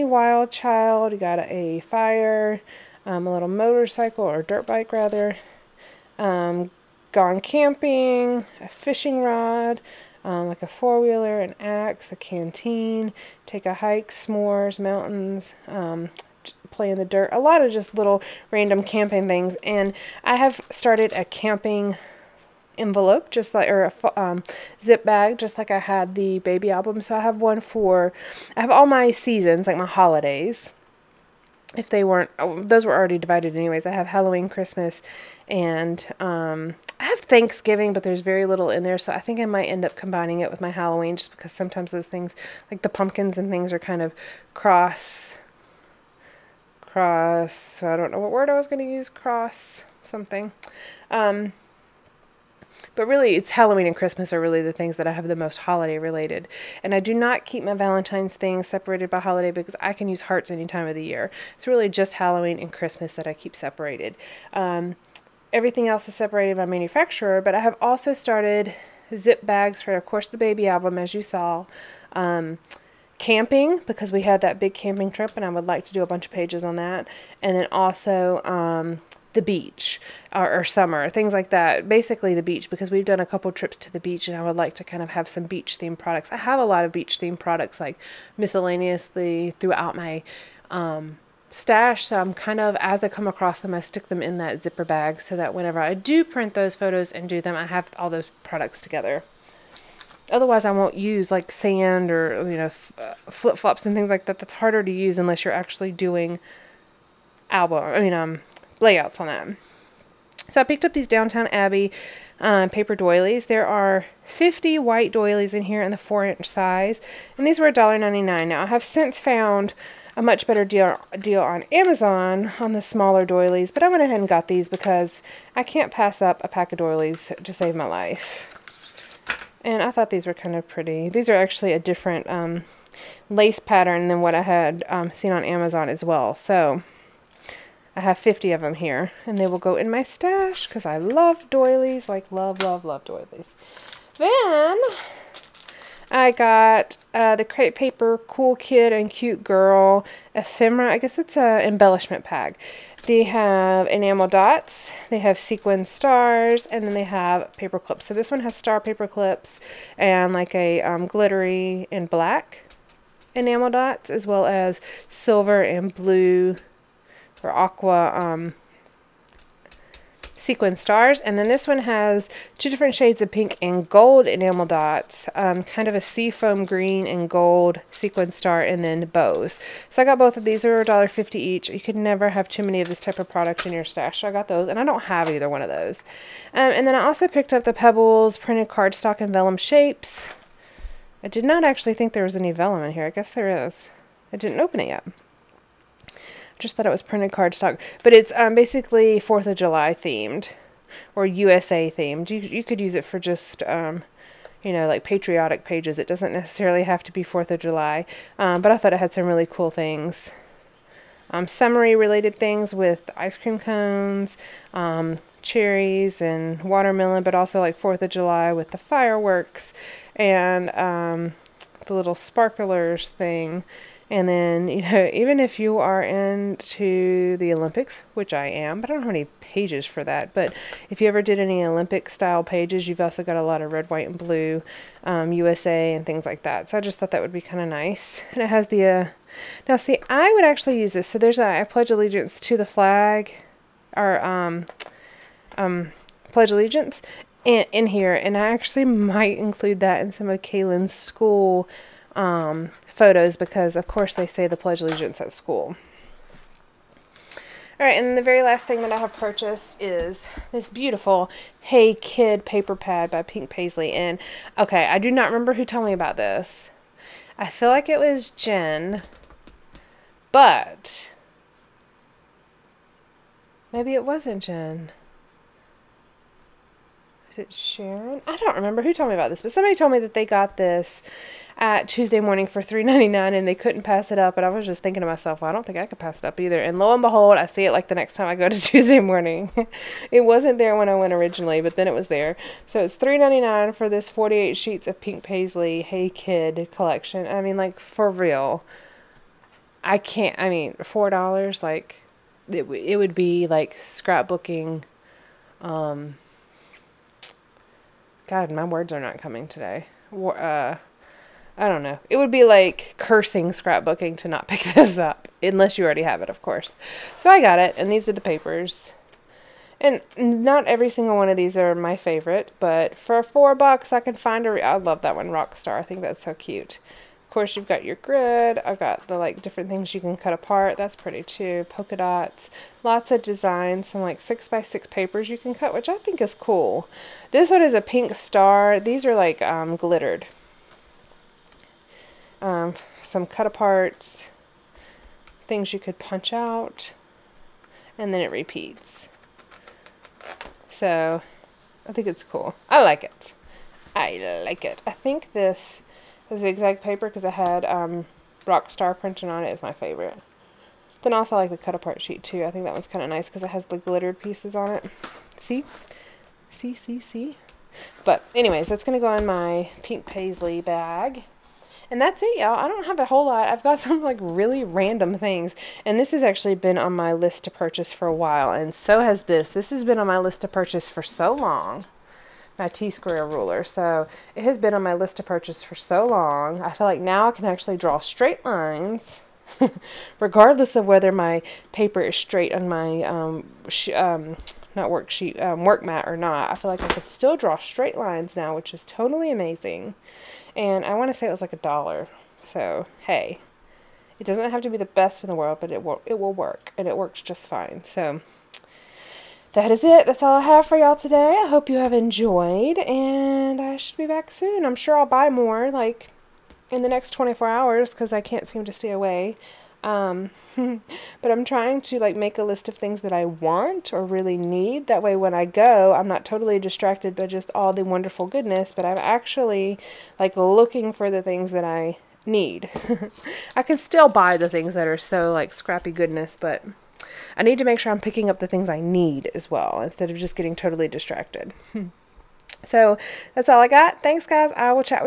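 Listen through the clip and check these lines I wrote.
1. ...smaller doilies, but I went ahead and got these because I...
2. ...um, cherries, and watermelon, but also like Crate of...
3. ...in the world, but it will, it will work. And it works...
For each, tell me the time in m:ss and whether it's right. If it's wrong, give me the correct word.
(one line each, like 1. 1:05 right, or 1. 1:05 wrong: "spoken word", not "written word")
1. 2:02 right
2. 3:34 wrong: "Fourth", not "Crate"
3. 6:45 right.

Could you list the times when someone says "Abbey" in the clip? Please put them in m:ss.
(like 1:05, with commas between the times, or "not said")
1:51.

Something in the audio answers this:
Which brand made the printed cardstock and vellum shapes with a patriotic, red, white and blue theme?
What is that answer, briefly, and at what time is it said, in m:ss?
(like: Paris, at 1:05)
Pebbles, at 3:07.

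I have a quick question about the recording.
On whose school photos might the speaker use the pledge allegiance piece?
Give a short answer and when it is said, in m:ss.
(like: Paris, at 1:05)
Kaylin, at 4:10.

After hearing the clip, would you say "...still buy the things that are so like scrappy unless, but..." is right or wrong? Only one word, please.
wrong.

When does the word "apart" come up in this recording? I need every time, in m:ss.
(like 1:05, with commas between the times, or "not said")
5:30, 5:43, 6:01.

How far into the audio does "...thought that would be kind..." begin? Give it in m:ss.
3:56.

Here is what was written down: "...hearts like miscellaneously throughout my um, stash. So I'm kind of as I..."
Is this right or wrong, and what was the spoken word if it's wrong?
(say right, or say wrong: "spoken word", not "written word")
wrong: "products", not "hearts".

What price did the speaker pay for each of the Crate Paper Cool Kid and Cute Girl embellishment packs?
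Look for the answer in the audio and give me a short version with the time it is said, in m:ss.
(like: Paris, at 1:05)
$1.50, at 3:00.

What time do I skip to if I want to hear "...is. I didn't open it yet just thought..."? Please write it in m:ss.
3:13.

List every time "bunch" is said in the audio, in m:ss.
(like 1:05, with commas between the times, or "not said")
1:16.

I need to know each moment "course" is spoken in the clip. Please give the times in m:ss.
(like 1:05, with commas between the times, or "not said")
1:10, 4:13, 5:16, 5:27.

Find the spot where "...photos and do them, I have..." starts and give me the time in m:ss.
1:36.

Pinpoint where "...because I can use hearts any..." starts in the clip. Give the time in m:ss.
0:59.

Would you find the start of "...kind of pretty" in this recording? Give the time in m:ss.
2:10.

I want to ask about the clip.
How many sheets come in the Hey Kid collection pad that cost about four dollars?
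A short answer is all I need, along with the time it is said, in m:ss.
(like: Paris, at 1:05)
48, at 4:54.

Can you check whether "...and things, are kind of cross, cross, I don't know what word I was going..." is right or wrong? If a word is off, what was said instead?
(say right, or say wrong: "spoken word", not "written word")
right.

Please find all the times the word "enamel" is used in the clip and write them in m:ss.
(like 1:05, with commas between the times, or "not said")
2:33, 2:43, 2:54.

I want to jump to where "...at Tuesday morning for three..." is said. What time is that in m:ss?
4:41.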